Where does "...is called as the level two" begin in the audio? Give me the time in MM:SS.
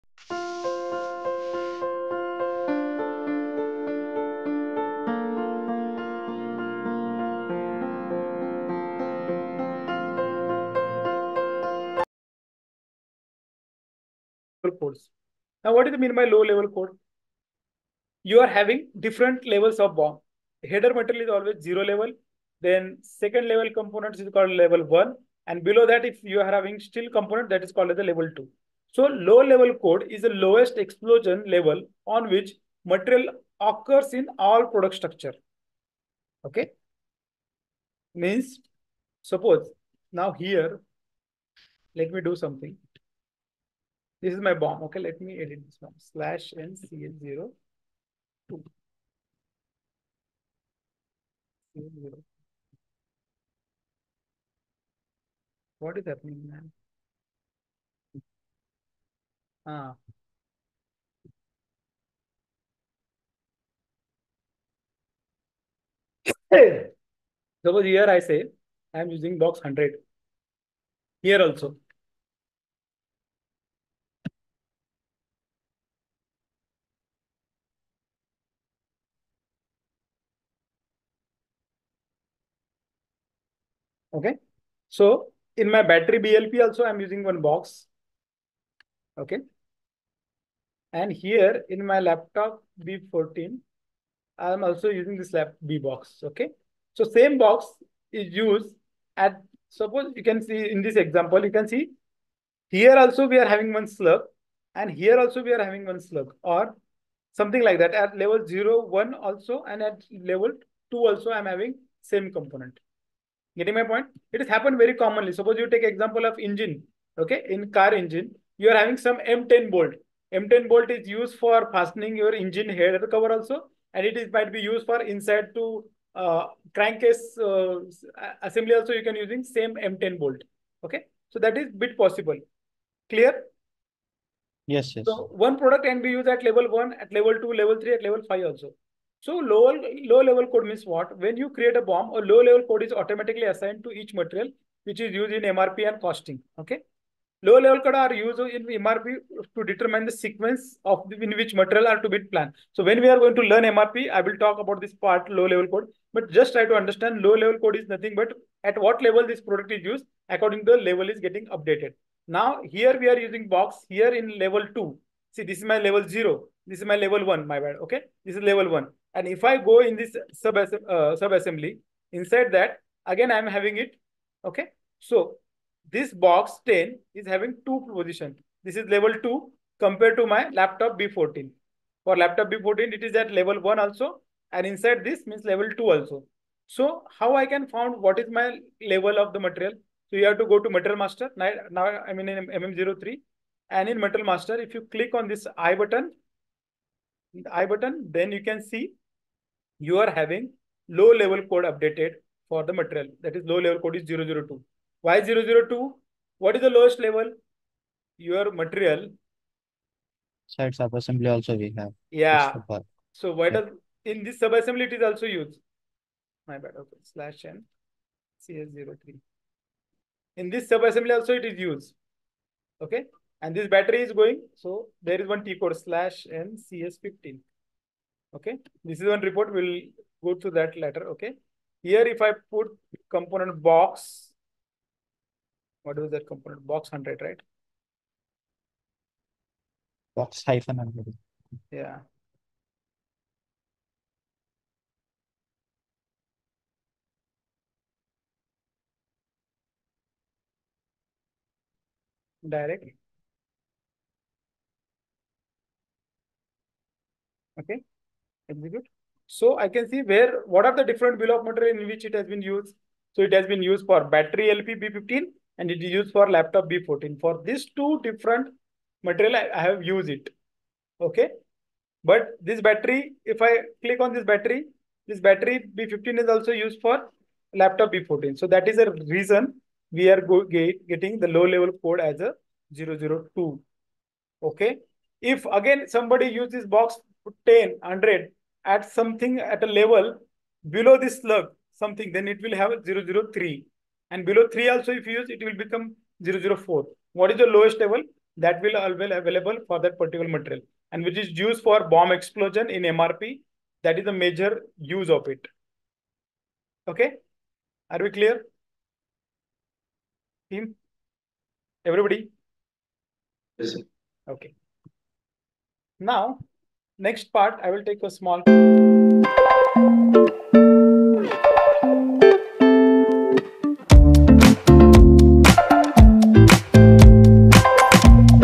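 00:27.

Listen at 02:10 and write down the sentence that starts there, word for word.
Okay, so that is bit possible.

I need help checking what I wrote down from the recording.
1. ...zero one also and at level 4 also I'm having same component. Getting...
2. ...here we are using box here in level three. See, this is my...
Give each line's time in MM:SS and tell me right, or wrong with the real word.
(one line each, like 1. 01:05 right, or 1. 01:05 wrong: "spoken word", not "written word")
1. 01:48 wrong: "2", not "4"
2. 02:42 wrong: "two", not "three".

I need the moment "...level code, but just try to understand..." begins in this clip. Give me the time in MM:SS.
02:35.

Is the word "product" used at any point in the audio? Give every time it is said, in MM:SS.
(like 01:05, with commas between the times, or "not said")
00:34, 02:15, 02:39.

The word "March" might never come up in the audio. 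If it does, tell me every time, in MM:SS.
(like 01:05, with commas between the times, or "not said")
not said.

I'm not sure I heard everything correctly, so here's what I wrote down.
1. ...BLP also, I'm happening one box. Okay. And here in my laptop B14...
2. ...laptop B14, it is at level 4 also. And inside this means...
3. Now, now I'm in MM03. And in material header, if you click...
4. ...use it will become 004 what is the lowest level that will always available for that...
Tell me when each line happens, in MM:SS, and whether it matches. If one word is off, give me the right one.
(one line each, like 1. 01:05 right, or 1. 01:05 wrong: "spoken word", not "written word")
1. 01:26 wrong: "using", not "happening"
2. 03:02 wrong: "1", not "4"
3. 03:11 wrong: "master", not "header"
4. 04:55 right.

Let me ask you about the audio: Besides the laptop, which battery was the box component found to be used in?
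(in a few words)
battery LP B15.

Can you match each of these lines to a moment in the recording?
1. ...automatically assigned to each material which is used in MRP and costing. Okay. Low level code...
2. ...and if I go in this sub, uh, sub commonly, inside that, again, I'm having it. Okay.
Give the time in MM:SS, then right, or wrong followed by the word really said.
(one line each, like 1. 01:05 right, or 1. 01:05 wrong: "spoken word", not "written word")
1. 02:22 right
2. 02:49 wrong: "assembly", not "commonly".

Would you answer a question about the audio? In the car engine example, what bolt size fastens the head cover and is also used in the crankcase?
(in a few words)
M10.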